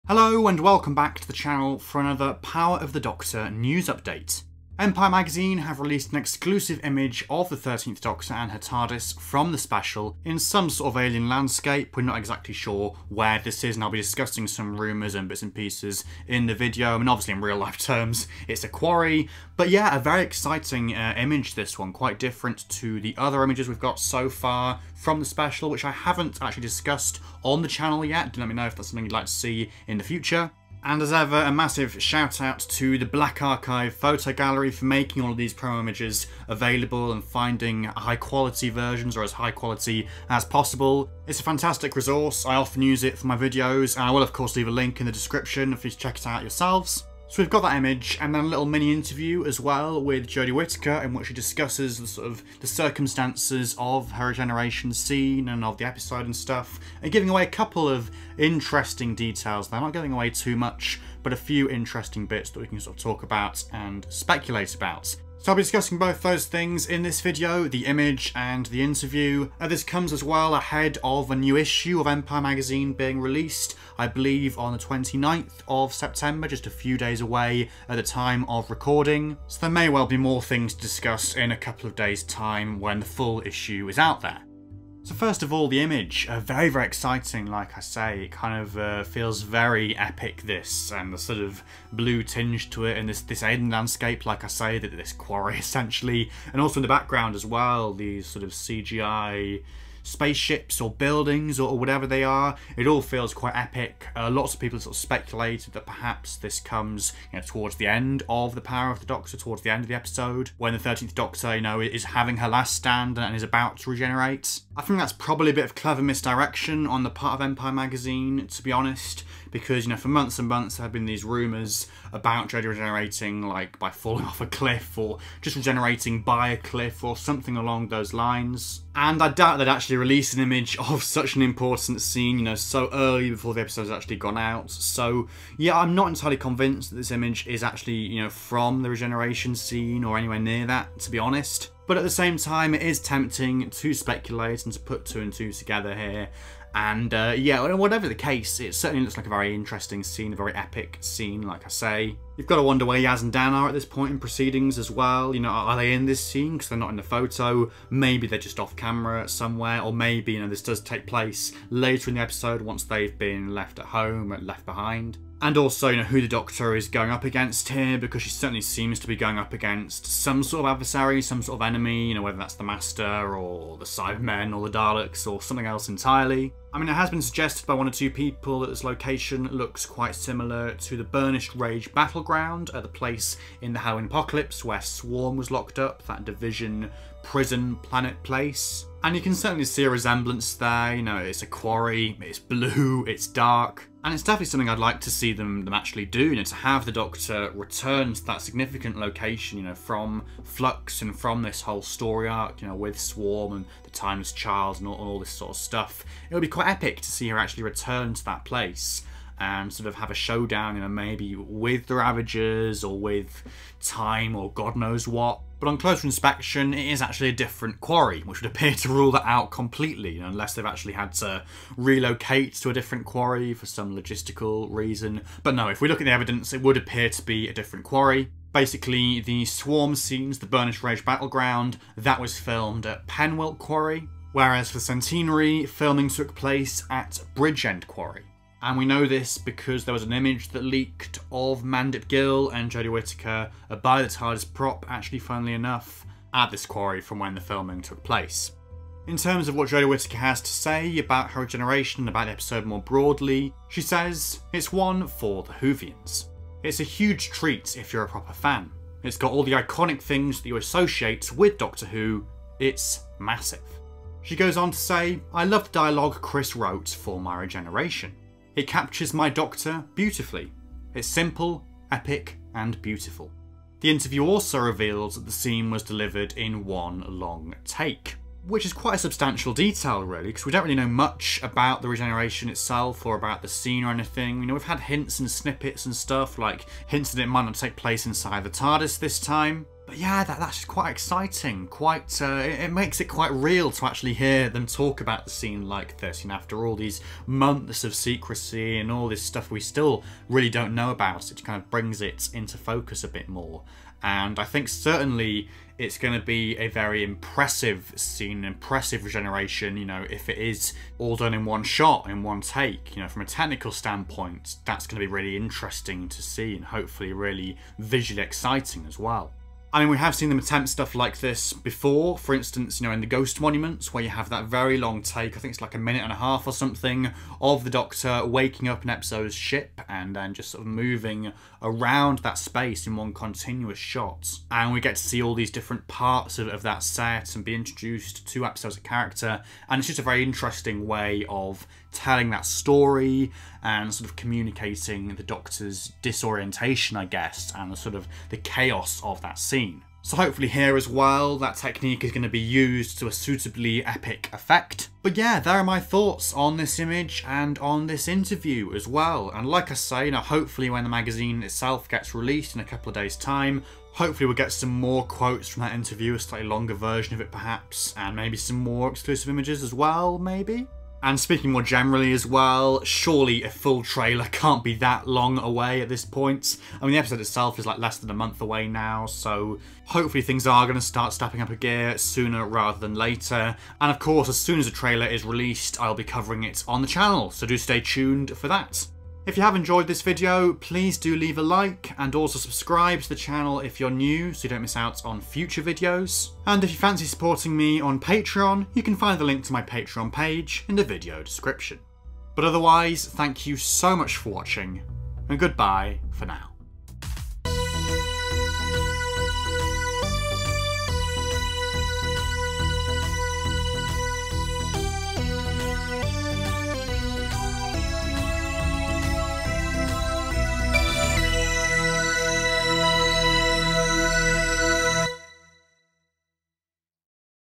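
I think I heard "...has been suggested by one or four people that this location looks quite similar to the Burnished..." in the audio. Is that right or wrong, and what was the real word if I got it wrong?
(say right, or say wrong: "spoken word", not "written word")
wrong: "two", not "four".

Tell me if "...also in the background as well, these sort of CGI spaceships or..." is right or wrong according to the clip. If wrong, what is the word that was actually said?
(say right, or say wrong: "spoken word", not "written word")
right.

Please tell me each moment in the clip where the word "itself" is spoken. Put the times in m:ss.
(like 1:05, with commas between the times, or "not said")
4:42, 6:01, 6:17.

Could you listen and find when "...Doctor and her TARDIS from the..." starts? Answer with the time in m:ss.
0:08.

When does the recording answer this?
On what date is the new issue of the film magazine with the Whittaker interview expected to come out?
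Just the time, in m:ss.
1:14.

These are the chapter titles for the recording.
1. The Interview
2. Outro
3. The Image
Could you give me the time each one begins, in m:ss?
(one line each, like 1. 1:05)
1. 4:09
2. 5:55
3. 1:25.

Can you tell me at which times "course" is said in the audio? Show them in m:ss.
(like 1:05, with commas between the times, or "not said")
0:44, 6:23.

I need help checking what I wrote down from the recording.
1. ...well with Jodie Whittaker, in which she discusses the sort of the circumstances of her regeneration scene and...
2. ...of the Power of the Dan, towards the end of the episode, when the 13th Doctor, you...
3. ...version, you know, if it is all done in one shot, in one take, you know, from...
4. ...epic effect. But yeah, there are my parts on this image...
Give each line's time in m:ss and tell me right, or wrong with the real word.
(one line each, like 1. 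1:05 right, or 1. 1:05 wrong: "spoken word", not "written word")
1. 0:49 right
2. 1:48 wrong: "Doctor", not "Dan"
3. 5:09 wrong: "regeneration", not "version"
4. 5:53 wrong: "thoughts", not "parts".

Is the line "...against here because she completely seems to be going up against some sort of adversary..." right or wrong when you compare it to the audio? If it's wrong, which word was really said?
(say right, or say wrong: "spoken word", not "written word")
wrong: "certainly", not "completely".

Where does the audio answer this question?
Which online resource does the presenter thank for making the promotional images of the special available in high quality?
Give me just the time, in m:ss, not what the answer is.
0:33.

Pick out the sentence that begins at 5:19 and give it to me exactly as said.
I mean, we have seen them attempt stuff like this before.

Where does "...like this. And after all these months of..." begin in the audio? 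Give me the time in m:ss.
4:55.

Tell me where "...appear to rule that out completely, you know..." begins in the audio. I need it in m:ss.
3:38.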